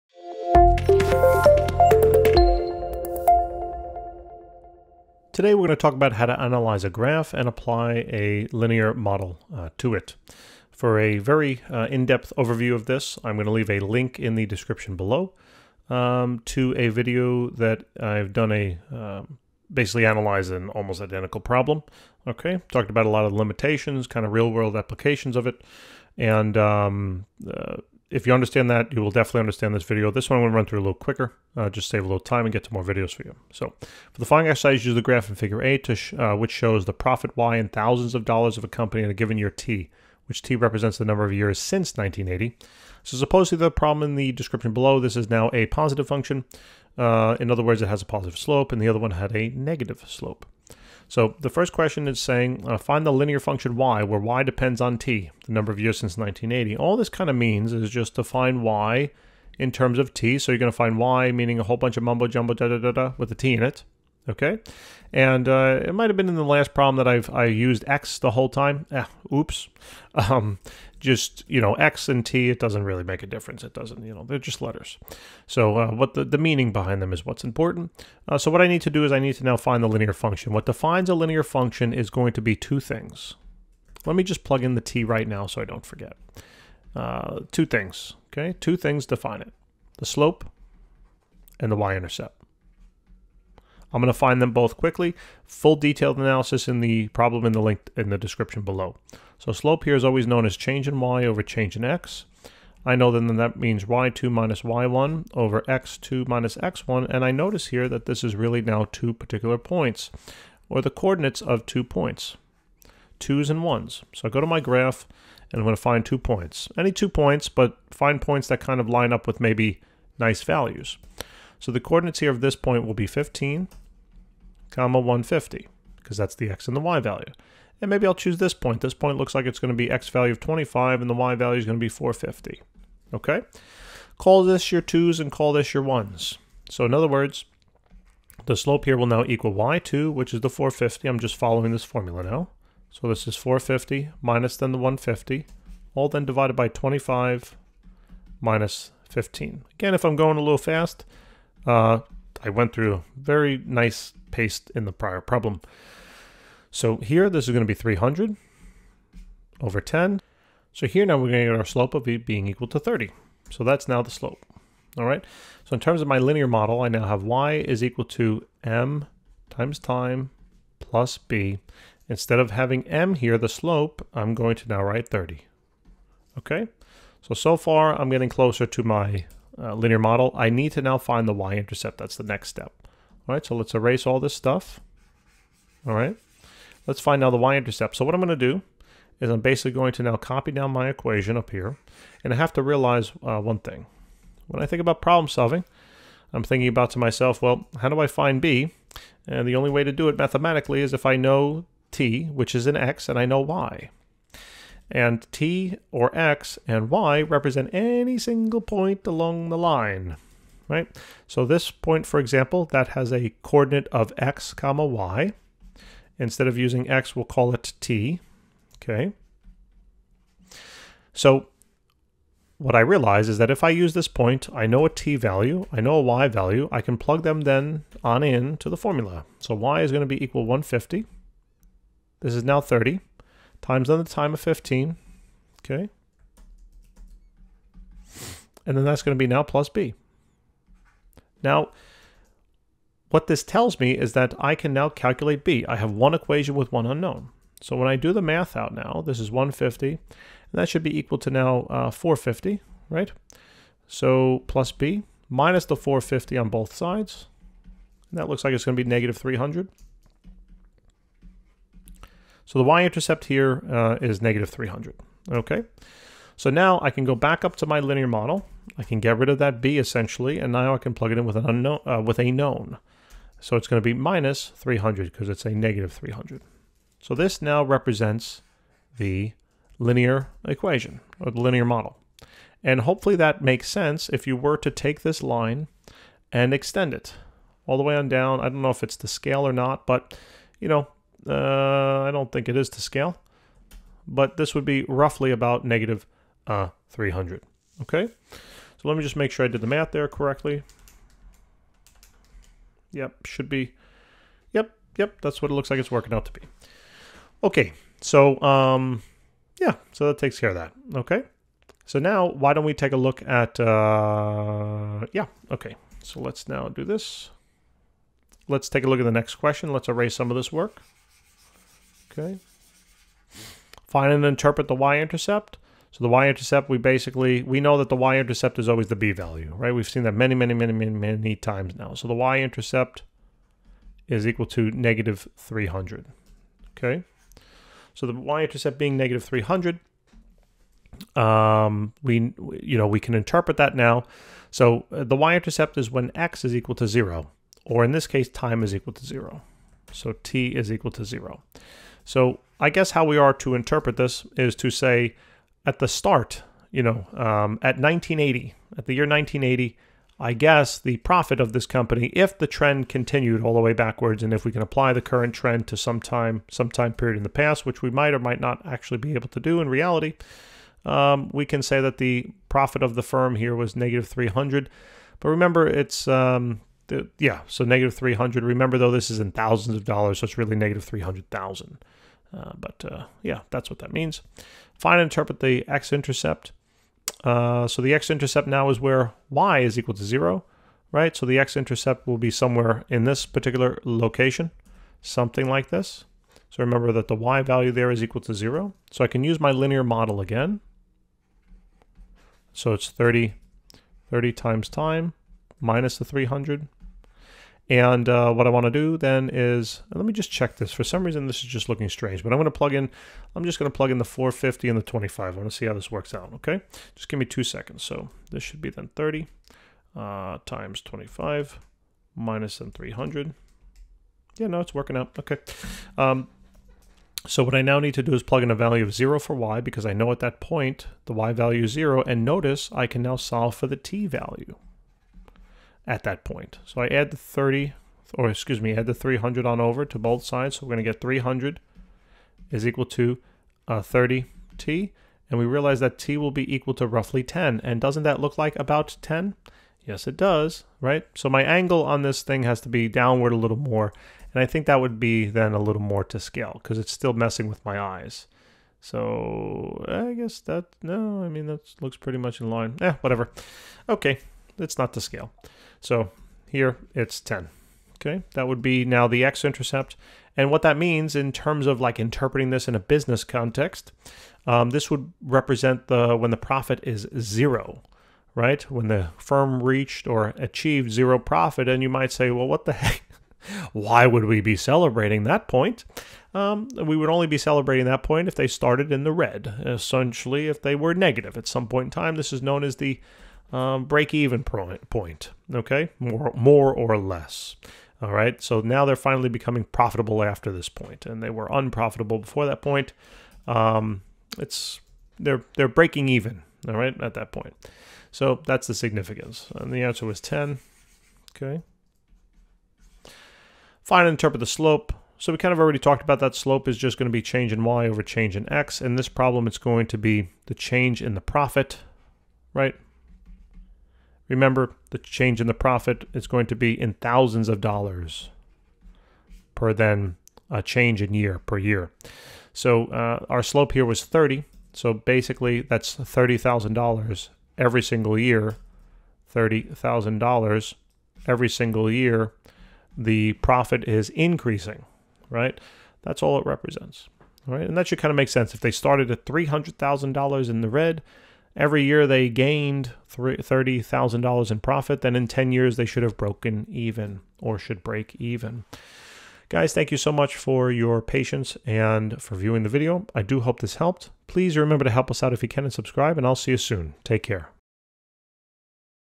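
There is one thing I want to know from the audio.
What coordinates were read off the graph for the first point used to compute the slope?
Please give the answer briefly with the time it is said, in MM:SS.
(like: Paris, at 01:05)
15, 150, at 02:03.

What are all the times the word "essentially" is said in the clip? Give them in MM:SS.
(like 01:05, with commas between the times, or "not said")
04:29, 08:09.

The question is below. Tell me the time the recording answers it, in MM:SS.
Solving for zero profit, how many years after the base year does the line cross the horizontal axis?
07:26.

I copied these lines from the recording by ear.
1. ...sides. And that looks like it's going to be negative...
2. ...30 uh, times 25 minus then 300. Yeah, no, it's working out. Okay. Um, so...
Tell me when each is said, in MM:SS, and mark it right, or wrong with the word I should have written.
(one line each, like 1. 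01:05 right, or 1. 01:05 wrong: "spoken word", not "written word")
1. 04:16 right
2. 06:58 right.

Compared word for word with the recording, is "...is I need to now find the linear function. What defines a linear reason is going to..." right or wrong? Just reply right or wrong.
wrong.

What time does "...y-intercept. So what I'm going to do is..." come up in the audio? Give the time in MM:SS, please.
03:07.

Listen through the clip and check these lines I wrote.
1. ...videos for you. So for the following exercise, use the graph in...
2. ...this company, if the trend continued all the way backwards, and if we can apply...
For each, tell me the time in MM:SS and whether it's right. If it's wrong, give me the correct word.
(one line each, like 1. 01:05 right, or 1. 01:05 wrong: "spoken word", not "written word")
1. 00:32 right
2. 06:01 right.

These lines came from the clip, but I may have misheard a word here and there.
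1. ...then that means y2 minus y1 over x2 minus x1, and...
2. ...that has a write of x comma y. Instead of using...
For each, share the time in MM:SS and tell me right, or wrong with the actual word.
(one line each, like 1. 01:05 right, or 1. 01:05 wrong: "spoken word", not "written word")
1. 01:43 right
2. 03:32 wrong: "coordinate", not "write".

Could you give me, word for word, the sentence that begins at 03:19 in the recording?
And the only way to do it mathematically is if I know t, which is an x, and I know y.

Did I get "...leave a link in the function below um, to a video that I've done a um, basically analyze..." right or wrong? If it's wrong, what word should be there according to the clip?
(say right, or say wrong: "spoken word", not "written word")
wrong: "description", not "function".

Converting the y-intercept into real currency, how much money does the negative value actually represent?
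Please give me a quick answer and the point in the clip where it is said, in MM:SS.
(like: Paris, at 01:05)
negative 300,000, at 06:20.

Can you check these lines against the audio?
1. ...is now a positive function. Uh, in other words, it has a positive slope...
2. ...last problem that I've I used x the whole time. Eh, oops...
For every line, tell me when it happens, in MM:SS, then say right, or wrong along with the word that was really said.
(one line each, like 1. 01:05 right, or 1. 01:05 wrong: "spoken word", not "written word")
1. 00:45 right
2. 01:06 right.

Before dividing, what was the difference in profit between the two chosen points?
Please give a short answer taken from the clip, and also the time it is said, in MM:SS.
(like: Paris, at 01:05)
300, at 02:37.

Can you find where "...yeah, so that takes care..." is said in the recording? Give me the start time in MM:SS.
05:09.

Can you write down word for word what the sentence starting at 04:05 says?
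I have one equation with one unknown.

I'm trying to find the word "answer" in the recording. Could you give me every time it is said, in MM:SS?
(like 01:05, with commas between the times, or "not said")
08:29.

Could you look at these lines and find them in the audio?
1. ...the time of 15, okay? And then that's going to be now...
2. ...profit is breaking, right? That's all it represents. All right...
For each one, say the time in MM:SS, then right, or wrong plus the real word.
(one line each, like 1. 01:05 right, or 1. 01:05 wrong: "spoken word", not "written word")
1. 03:53 right
2. 09:03 wrong: "increasing", not "breaking".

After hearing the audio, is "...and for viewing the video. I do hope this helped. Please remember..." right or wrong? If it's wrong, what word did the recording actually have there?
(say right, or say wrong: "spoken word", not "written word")
right.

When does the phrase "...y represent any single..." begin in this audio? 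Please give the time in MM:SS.
03:26.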